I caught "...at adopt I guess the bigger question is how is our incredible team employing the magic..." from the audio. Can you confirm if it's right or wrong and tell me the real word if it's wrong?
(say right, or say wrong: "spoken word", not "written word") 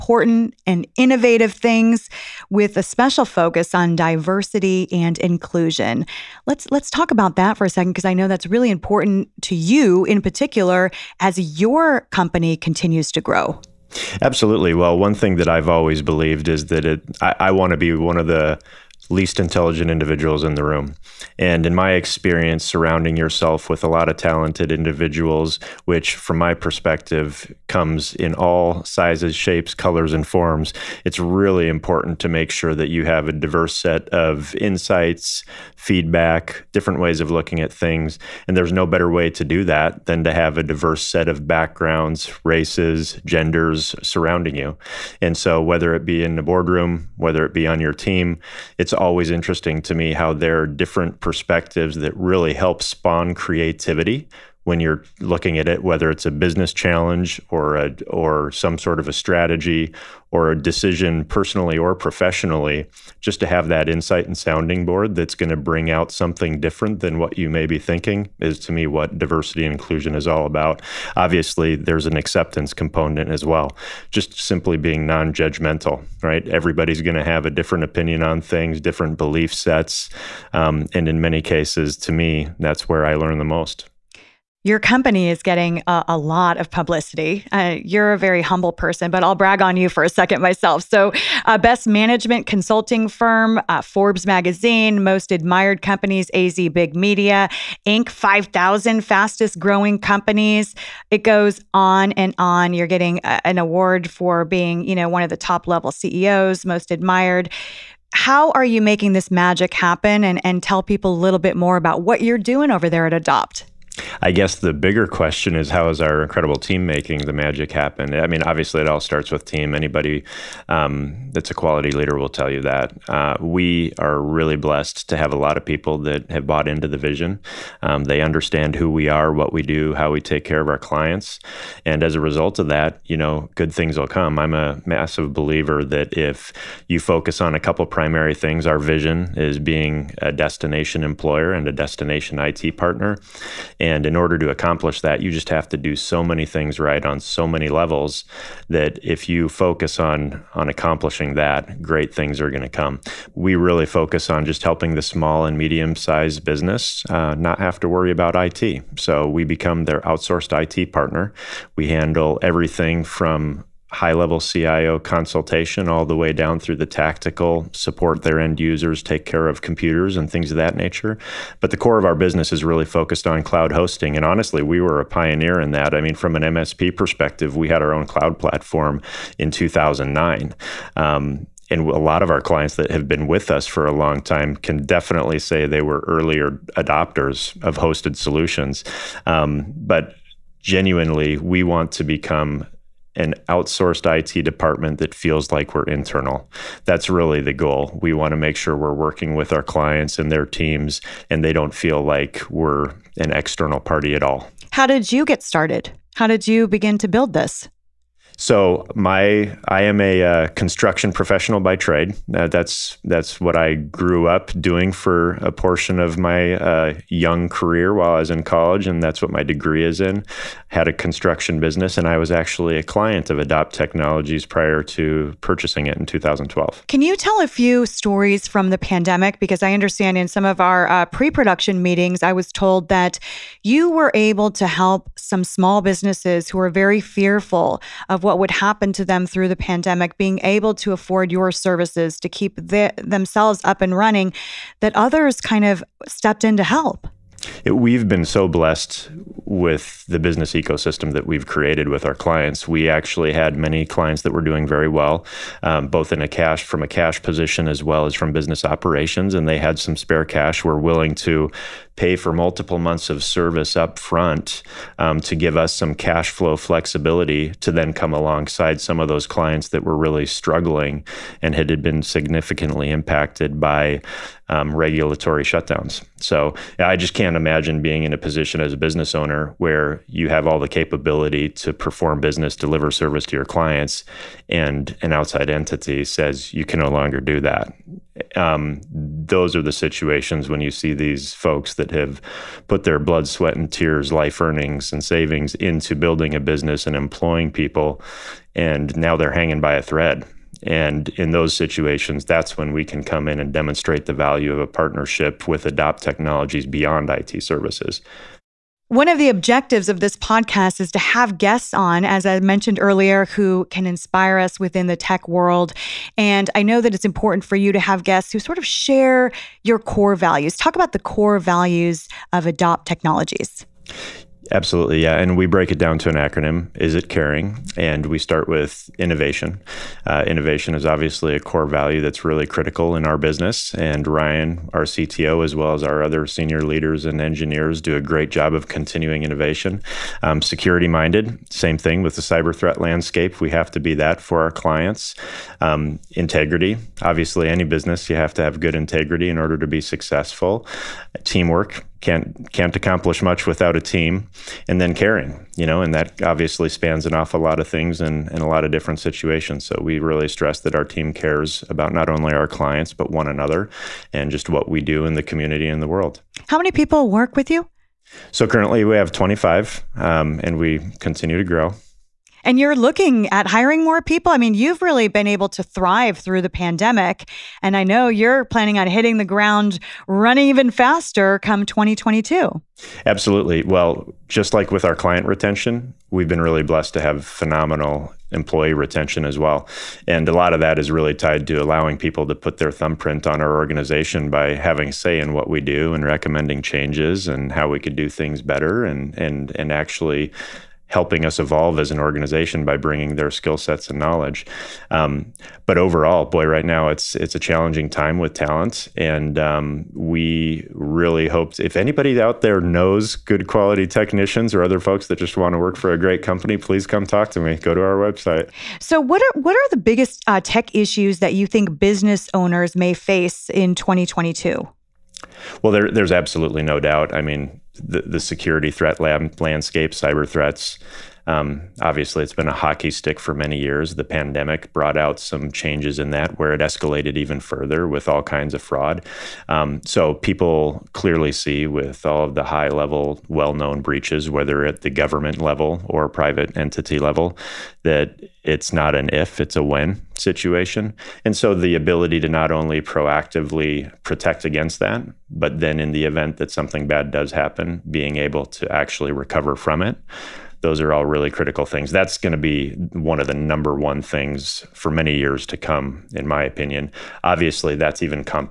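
wrong: "making", not "employing".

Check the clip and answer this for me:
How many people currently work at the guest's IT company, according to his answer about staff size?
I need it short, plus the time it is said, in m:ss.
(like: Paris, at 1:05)
25, at 6:09.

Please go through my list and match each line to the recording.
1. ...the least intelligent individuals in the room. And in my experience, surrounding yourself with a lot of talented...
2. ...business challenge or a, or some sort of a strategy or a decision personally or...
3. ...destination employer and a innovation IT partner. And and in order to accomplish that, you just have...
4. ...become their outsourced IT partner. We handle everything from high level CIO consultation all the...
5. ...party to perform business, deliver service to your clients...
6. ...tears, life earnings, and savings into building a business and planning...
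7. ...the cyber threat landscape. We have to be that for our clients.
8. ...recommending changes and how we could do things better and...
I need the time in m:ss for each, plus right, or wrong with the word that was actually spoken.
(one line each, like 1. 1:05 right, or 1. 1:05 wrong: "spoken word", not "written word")
1. 0:18 right
2. 0:56 right
3. 2:20 wrong: "destination", not "innovation"
4. 2:39 right
5. 4:40 wrong: "capability", not "party"
6. 4:53 wrong: "employing", not "planning"
7. 5:42 right
8. 6:36 right.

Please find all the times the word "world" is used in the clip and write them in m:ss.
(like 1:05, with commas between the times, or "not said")
5:15, 6:05.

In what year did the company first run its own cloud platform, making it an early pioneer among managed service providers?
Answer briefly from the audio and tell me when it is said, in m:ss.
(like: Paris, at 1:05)
2009, at 2:59.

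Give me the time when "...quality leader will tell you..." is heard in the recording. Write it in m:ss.
2:01.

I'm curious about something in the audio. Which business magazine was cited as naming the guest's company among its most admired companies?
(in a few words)
Forbes.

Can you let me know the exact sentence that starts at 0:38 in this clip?
And there's no better way to do that than to have a diverse set of backgrounds, races, genders surrounding you.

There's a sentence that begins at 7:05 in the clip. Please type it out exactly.
Well, there, there's absolutely no doubt.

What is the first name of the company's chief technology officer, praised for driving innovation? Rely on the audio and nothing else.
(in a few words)
Ryan.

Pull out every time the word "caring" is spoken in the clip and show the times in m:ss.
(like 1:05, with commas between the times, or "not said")
5:27, 5:54.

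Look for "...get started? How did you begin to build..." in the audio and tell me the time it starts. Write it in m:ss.
3:25.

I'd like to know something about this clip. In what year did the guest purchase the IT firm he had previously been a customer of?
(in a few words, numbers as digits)
2012.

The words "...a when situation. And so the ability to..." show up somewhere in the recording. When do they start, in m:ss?
7:29.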